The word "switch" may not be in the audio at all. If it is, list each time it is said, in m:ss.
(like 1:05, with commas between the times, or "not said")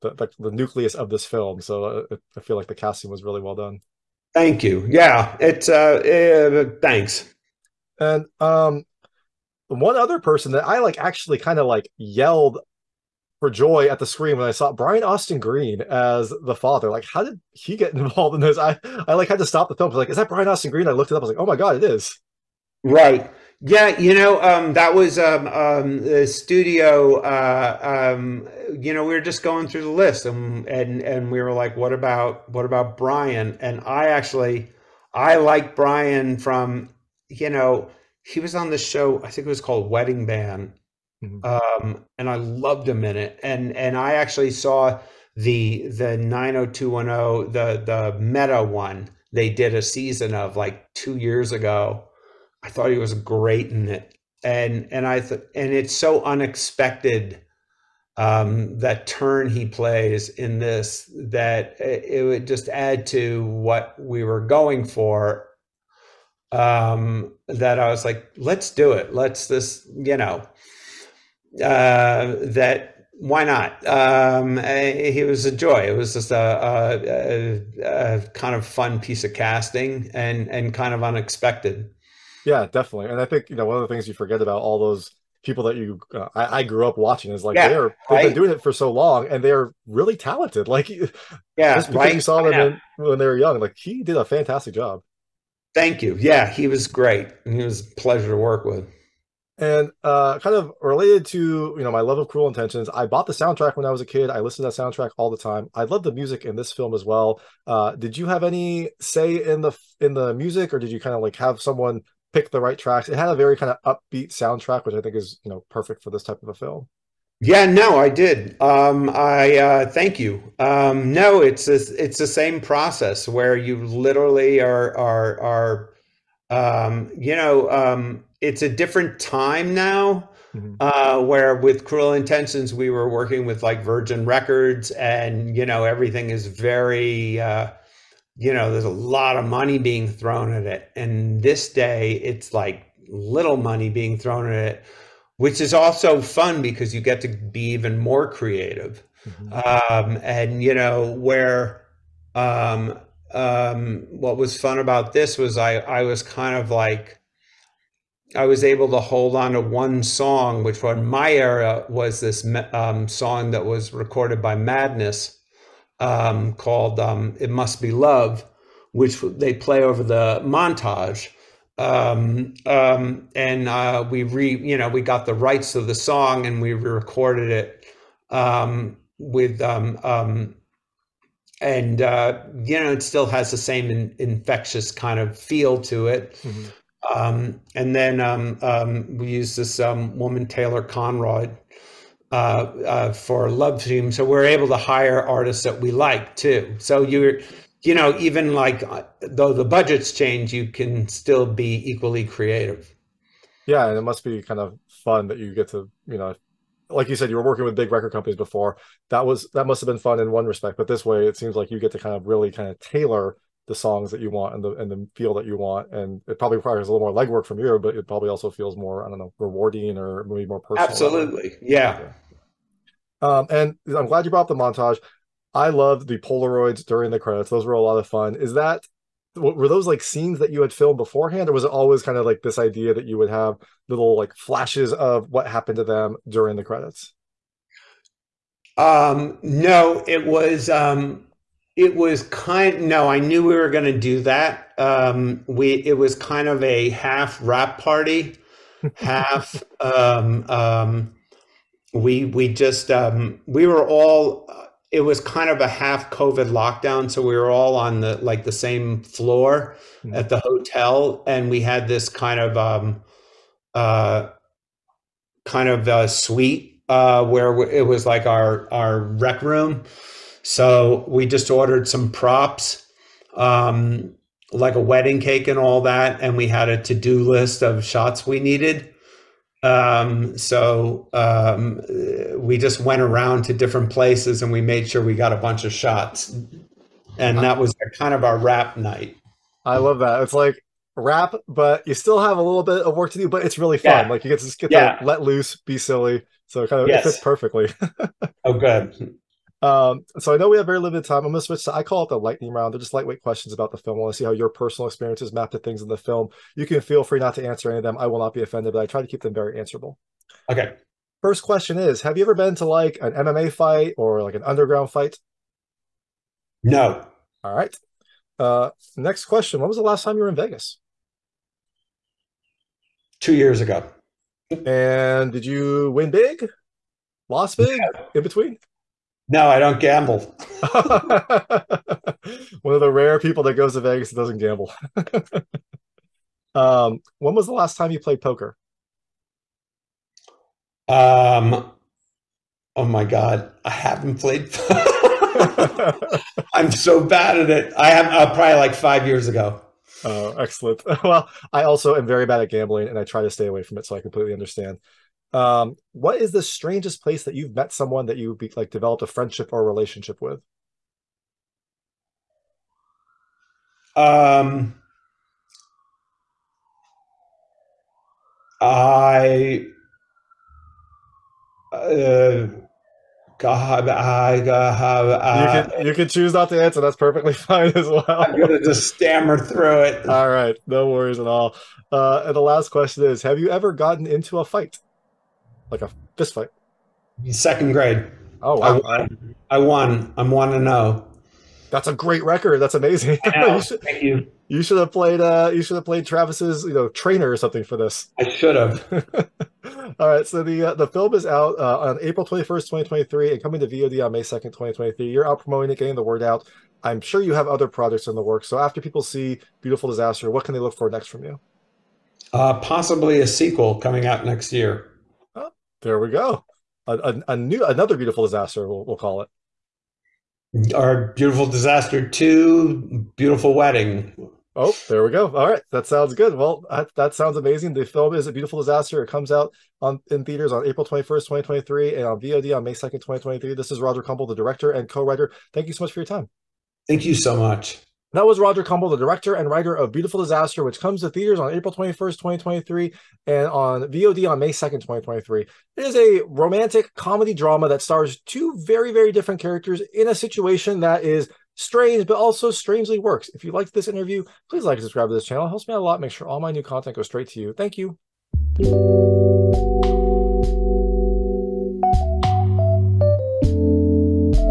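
5:01.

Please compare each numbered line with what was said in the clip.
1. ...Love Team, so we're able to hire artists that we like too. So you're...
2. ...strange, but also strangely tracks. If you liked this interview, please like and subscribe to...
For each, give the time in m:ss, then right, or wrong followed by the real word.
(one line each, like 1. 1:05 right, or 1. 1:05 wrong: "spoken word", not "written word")
1. 3:13 right
2. 7:31 wrong: "works", not "tracks".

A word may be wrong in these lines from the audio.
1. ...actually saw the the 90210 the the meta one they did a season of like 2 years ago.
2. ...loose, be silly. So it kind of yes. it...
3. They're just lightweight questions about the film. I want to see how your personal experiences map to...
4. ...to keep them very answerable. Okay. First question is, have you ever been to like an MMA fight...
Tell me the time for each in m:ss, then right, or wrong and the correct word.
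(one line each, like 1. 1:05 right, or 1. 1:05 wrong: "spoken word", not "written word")
1. 0:44 right
2. 4:55 right
3. 5:02 right
4. 5:09 right.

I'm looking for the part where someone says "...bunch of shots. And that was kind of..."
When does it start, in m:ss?
4:45.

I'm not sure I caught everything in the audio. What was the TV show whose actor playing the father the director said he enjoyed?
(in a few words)
Wedding Band.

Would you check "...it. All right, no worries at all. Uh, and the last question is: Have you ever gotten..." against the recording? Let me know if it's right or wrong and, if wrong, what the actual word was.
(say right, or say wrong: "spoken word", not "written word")
right.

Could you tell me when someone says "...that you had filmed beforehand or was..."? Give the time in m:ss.
3:50.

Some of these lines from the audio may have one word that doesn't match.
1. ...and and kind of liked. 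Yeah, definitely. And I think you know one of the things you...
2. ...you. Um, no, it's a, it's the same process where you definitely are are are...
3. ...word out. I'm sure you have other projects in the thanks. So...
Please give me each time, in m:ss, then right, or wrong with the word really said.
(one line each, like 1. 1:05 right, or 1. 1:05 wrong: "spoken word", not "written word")
1. 1:20 wrong: "unexpected", not "liked"
2. 2:00 wrong: "literally", not "definitely"
3. 6:46 wrong: "works", not "thanks".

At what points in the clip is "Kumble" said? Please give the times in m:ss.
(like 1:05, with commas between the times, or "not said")
7:14, 7:18.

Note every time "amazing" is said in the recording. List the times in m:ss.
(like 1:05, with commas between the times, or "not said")
6:32, 7:07.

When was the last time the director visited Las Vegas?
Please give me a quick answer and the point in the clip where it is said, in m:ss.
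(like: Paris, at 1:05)
Two years ago, at 5:23.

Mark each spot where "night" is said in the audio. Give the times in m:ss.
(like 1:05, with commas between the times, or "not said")
4:48.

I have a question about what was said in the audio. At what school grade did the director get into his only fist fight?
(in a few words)
Second grade.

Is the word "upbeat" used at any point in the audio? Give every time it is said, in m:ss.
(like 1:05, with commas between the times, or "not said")
1:53.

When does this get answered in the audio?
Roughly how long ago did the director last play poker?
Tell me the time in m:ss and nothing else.
5:48.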